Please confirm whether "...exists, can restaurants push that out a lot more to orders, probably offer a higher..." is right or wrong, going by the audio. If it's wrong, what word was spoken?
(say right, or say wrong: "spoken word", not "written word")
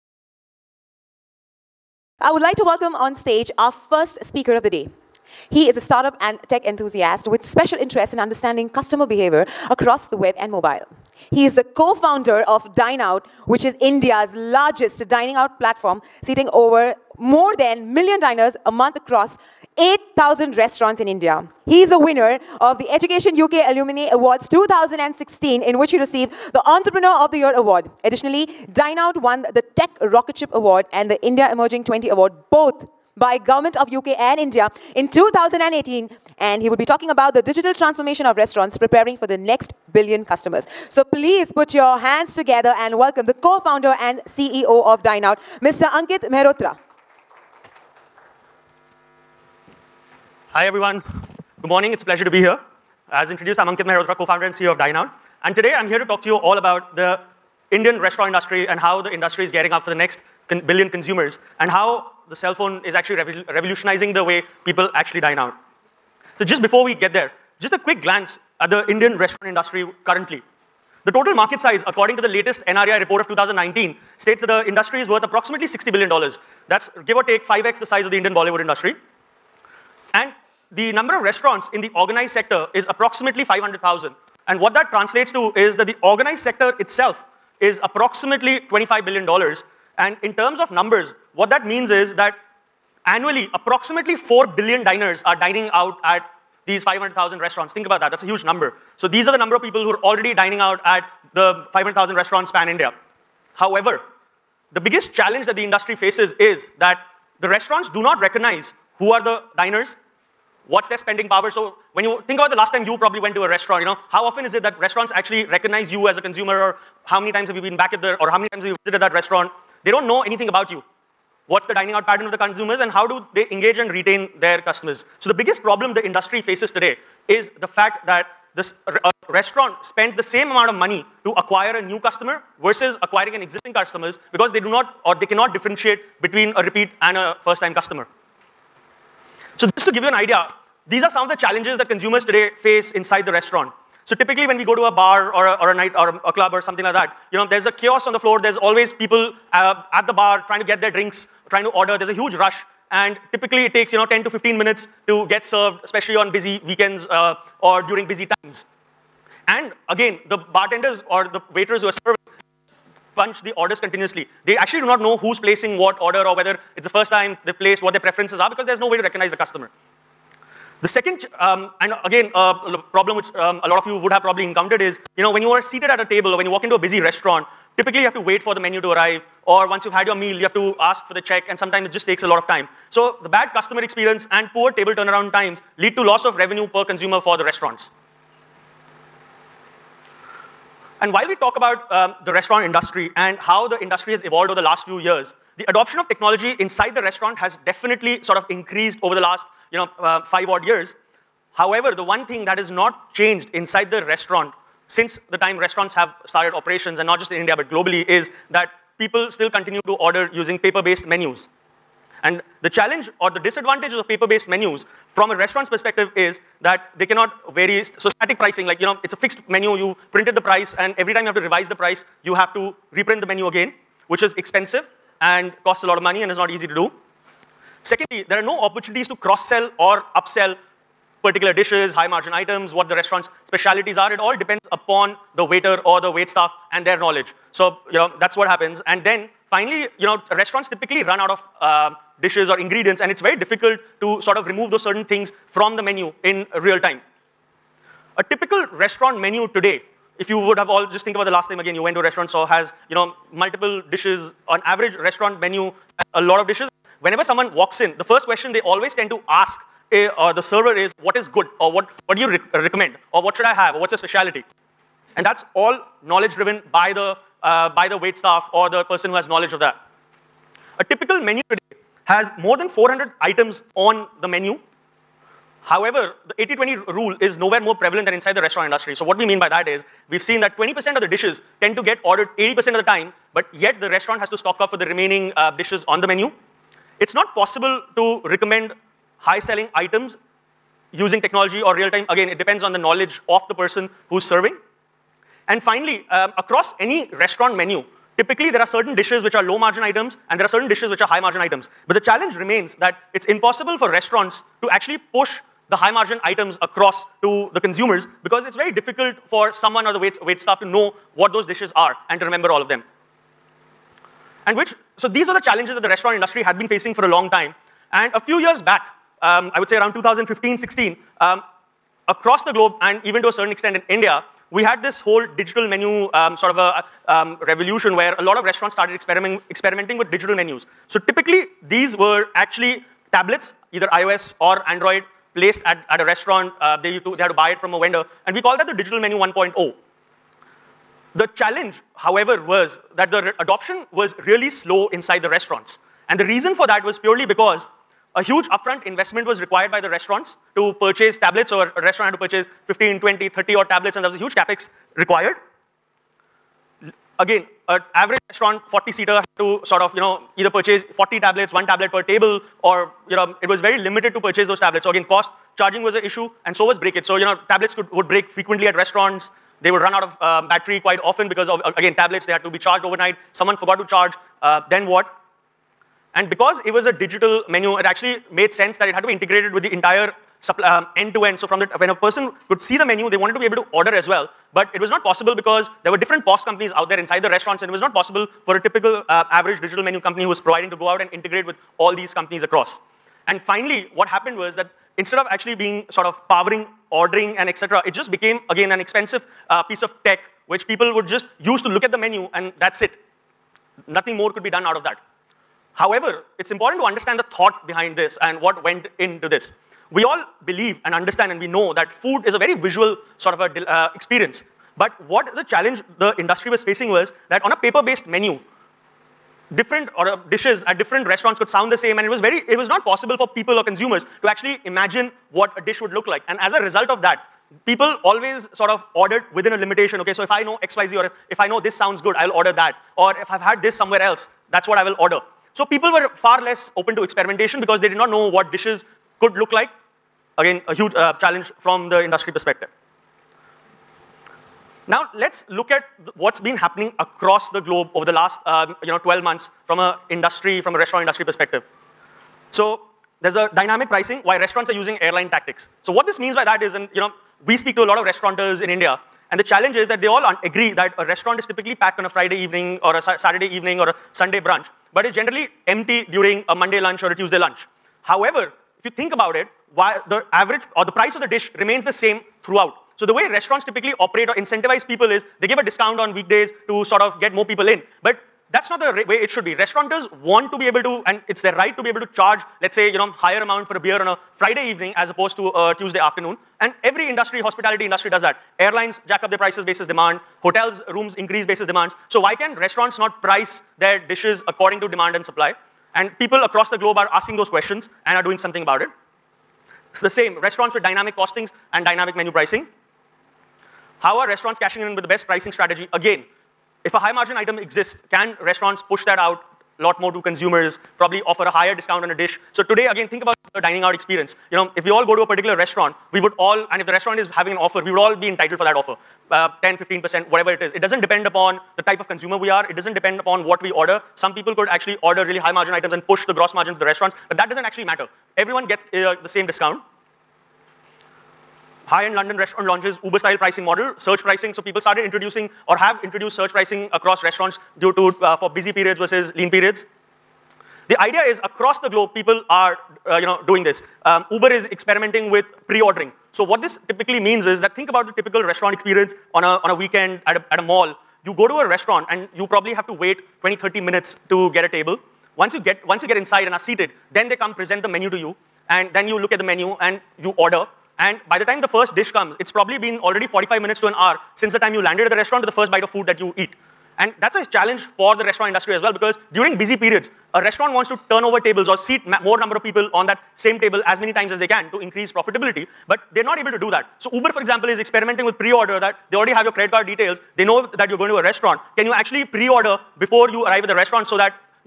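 wrong: "consumers", not "orders".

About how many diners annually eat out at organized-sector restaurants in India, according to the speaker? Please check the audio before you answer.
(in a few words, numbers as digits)
4 billion.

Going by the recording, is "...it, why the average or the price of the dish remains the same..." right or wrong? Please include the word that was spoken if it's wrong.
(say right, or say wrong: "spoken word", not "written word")
right.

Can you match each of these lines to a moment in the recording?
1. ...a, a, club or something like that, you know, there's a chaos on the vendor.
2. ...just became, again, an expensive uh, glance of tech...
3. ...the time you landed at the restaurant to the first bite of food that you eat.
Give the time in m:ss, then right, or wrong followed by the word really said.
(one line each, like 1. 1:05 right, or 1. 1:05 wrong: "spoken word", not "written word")
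1. 2:26 wrong: "floor", not "vendor"
2. 6:37 wrong: "piece", not "glance"
3. 9:24 right.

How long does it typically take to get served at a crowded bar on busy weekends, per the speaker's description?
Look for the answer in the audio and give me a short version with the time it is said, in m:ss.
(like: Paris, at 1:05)
10 to 15 minutes, at 2:34.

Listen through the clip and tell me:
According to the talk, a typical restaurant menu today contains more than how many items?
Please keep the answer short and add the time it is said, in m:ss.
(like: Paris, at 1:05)
400, at 4:32.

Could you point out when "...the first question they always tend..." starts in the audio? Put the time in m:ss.
4:17.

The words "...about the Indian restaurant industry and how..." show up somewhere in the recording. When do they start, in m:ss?
0:56.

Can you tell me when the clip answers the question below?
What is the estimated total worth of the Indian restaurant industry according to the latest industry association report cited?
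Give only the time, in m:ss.
1:15.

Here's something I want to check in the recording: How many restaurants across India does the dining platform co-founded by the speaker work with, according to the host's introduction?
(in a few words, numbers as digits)
8,000.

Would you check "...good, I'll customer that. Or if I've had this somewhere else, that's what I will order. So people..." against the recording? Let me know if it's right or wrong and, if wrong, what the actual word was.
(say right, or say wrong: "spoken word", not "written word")
wrong: "order", not "customer".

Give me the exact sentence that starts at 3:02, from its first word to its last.
So the bad customer experience and poor table turnaround times lead to loss of revenue per consumer for the restaurants.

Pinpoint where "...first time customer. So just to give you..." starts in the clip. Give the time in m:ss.
2:17.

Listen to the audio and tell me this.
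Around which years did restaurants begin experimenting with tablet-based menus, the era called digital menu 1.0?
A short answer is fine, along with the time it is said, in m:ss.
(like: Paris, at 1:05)
2015-16, at 5:19.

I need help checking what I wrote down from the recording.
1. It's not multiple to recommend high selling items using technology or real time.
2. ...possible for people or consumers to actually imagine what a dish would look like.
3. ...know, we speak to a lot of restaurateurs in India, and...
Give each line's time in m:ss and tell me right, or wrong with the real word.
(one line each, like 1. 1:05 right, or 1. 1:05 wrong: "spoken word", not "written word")
1. 4:46 wrong: "possible", not "multiple"
2. 7:02 right
3. 7:37 right.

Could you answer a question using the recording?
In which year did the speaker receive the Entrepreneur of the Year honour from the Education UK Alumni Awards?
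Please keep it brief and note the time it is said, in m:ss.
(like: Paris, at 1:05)
2016, at 0:24.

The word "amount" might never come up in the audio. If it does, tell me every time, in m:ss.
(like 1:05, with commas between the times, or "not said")
2:10, 8:03.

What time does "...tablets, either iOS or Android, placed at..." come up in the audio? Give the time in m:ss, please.
5:33.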